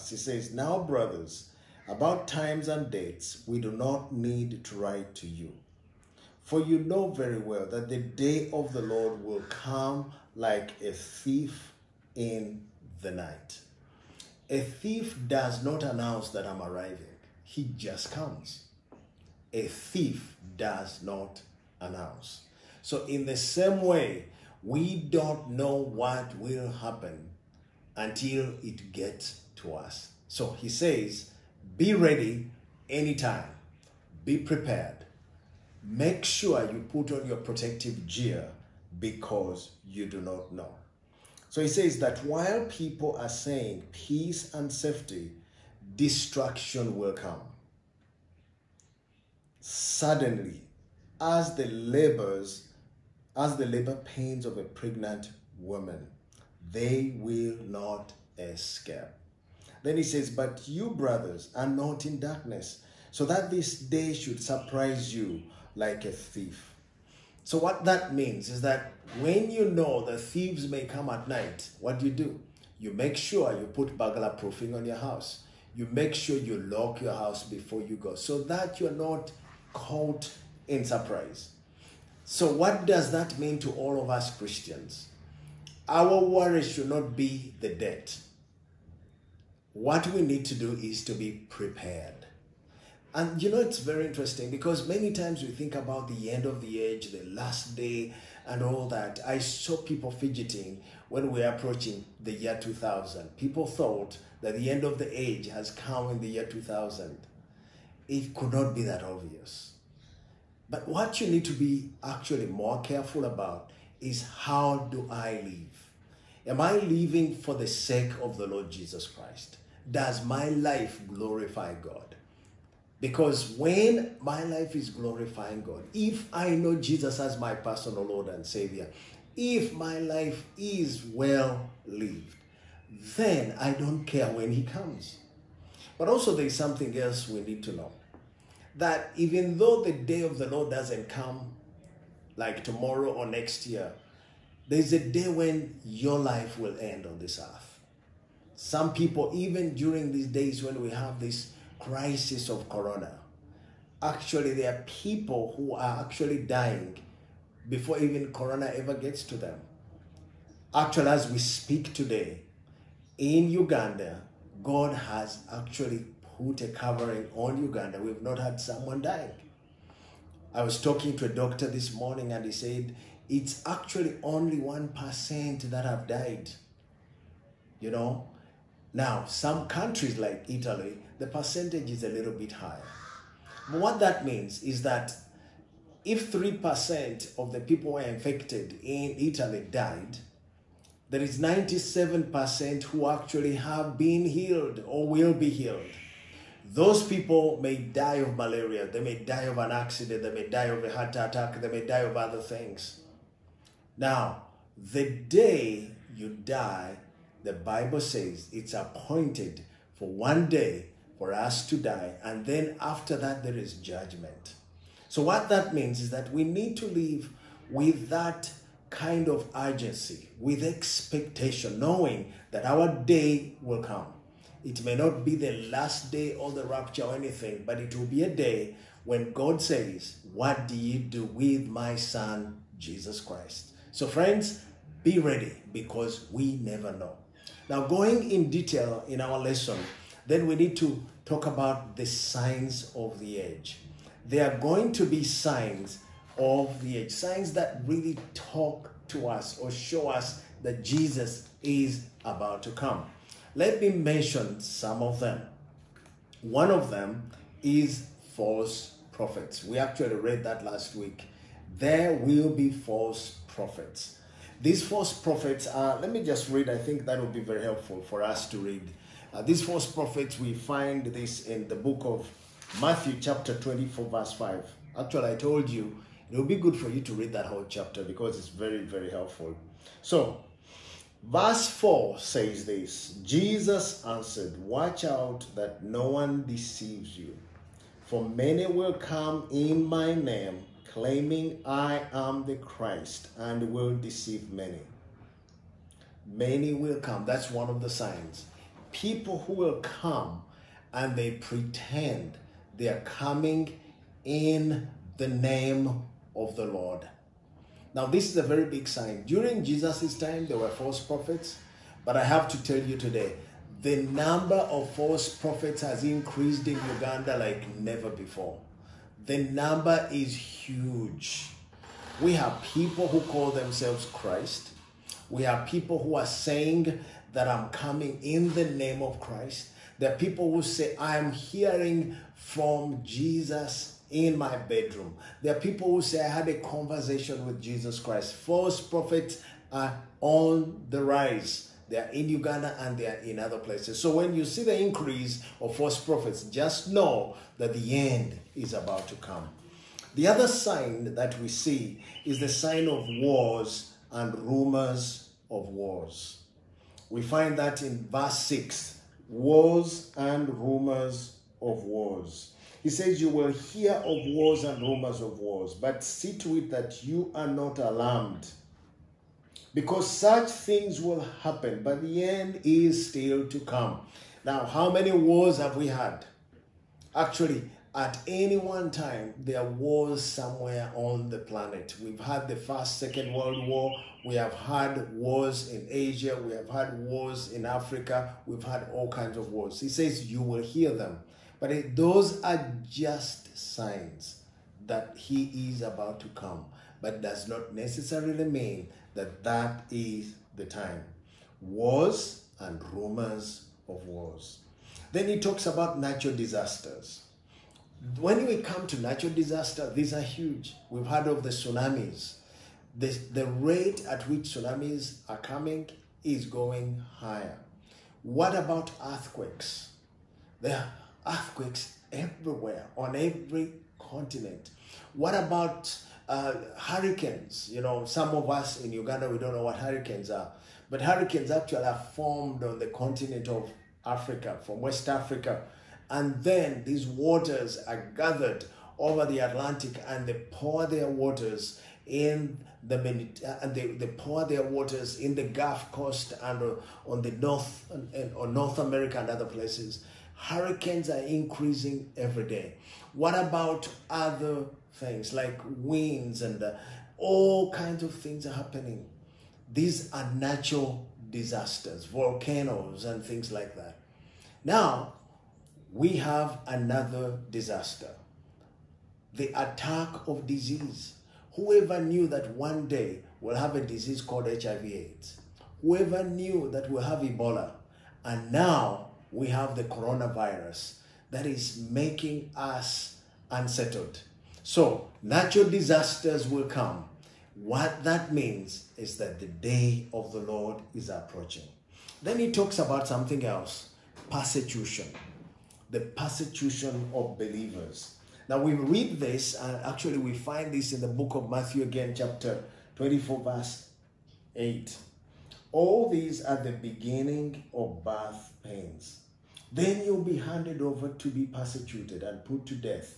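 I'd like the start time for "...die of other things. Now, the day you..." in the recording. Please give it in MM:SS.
03:21.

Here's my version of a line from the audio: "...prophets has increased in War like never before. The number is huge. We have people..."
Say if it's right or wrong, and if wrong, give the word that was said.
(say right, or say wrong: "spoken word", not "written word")
wrong: "Uganda", not "War".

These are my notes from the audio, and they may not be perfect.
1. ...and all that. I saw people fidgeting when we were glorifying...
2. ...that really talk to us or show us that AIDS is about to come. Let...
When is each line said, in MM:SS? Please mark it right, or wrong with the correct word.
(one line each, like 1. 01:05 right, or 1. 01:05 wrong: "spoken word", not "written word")
1. 01:38 wrong: "approaching", not "glorifying"
2. 04:07 wrong: "Jesus", not "AIDS".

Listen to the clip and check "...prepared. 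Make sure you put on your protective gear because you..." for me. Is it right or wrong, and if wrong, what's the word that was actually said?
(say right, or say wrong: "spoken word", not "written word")
right.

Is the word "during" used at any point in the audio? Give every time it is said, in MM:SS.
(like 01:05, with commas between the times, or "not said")
02:29, 05:09.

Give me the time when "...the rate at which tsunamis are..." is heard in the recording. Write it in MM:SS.
06:53.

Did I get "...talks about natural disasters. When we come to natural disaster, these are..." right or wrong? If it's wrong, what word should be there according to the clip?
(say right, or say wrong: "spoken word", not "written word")
right.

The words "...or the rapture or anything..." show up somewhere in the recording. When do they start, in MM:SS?
03:46.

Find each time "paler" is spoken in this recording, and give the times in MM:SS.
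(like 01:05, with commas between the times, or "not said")
not said.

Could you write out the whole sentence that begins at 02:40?
Actually, as we speak today in Uganda, God has actually Hute covering all Uganda.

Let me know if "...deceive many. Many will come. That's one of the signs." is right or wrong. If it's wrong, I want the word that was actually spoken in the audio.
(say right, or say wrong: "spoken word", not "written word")
right.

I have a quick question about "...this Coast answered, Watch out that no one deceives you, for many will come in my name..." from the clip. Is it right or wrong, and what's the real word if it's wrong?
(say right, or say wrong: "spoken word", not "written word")
wrong: "Jesus", not "Coast".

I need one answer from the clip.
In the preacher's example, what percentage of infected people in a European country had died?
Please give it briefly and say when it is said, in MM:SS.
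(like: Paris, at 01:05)
3%, at 03:06.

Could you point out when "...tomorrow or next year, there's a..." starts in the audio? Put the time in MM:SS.
02:22.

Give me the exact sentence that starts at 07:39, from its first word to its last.
These are natural disasters, volcanoes and things like that.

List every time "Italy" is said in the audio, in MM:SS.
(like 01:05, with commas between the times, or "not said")
03:00, 03:09.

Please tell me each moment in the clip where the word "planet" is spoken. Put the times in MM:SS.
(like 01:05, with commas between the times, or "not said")
06:21.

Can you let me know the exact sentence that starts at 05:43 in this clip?
So when you see the increase of false prophets, just know that the end is about to come.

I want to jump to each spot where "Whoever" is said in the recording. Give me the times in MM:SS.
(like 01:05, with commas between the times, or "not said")
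07:51, 07:55.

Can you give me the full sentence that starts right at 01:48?
It could not be that obvious.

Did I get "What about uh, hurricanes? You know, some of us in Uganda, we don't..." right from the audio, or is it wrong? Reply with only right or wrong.
right.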